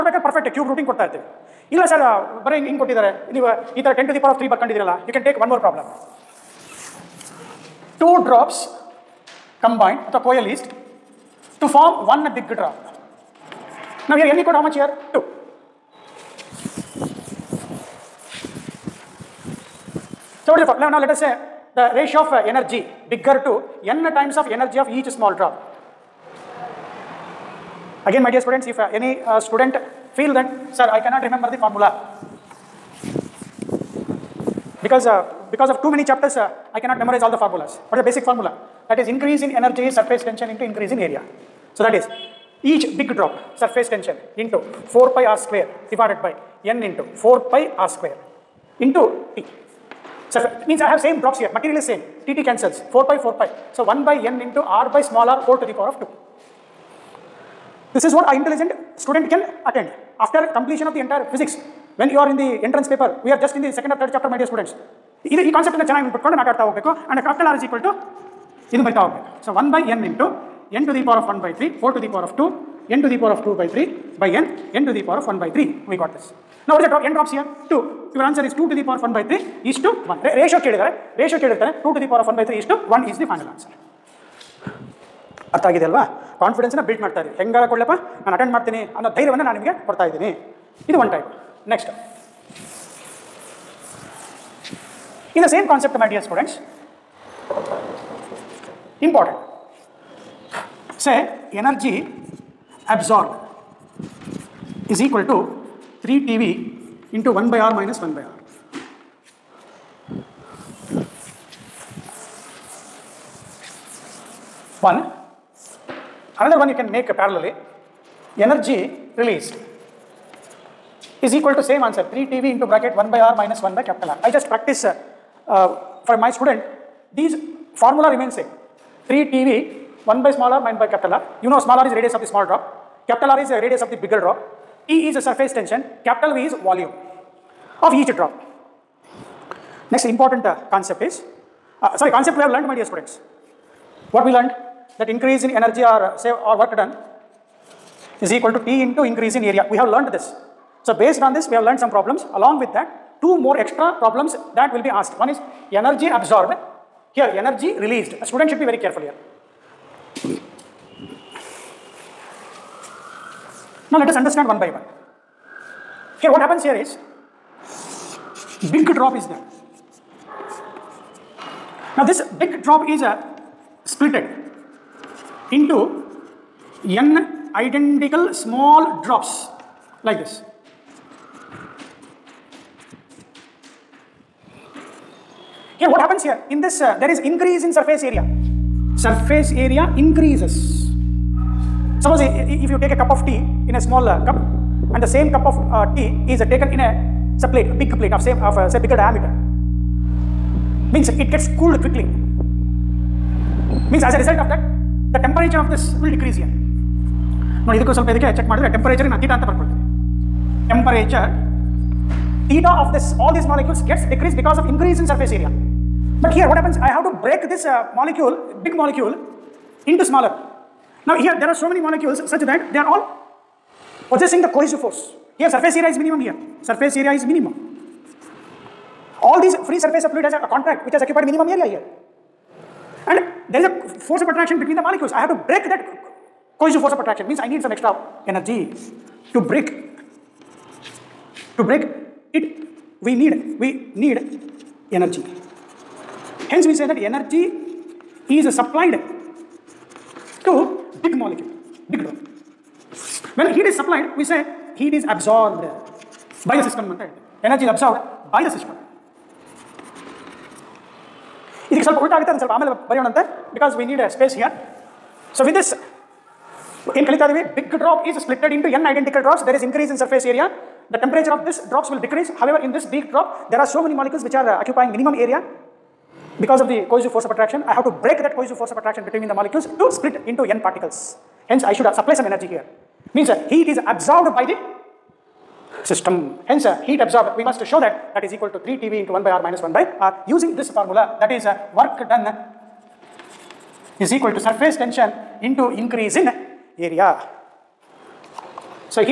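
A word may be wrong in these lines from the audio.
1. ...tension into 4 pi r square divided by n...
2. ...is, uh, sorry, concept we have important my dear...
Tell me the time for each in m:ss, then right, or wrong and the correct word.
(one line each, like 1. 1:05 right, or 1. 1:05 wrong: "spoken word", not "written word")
1. 0:43 right
2. 2:21 wrong: "learnt", not "important".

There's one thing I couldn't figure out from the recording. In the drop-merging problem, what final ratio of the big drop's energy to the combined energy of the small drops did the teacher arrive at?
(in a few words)
2^(1/3) : 1.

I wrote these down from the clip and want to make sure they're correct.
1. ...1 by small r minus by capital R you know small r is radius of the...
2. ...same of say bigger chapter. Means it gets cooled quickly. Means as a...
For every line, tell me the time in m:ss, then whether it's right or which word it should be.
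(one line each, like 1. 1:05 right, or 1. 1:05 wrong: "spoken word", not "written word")
1. 2:10 right
2. 3:18 wrong: "diameter", not "chapter".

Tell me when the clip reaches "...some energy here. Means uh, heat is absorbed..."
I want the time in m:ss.
4:42.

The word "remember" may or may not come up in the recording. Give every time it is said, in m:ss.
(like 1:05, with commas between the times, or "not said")
0:31.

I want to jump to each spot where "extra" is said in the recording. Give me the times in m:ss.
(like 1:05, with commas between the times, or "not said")
2:33, 3:57.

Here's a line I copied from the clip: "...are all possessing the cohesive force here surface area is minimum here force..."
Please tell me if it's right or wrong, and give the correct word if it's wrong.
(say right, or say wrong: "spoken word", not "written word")
wrong: "surface", not "force".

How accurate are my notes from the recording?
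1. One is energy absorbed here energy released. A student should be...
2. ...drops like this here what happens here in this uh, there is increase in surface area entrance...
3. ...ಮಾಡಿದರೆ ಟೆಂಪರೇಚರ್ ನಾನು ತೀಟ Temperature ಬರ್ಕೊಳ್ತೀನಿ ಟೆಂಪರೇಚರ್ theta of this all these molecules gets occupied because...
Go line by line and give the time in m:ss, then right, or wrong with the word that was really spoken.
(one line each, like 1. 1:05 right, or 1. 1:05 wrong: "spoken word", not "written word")
1. 2:35 right
2. 2:59 wrong: "surface", not "entrance"
3. 3:28 wrong: "decreased", not "occupied".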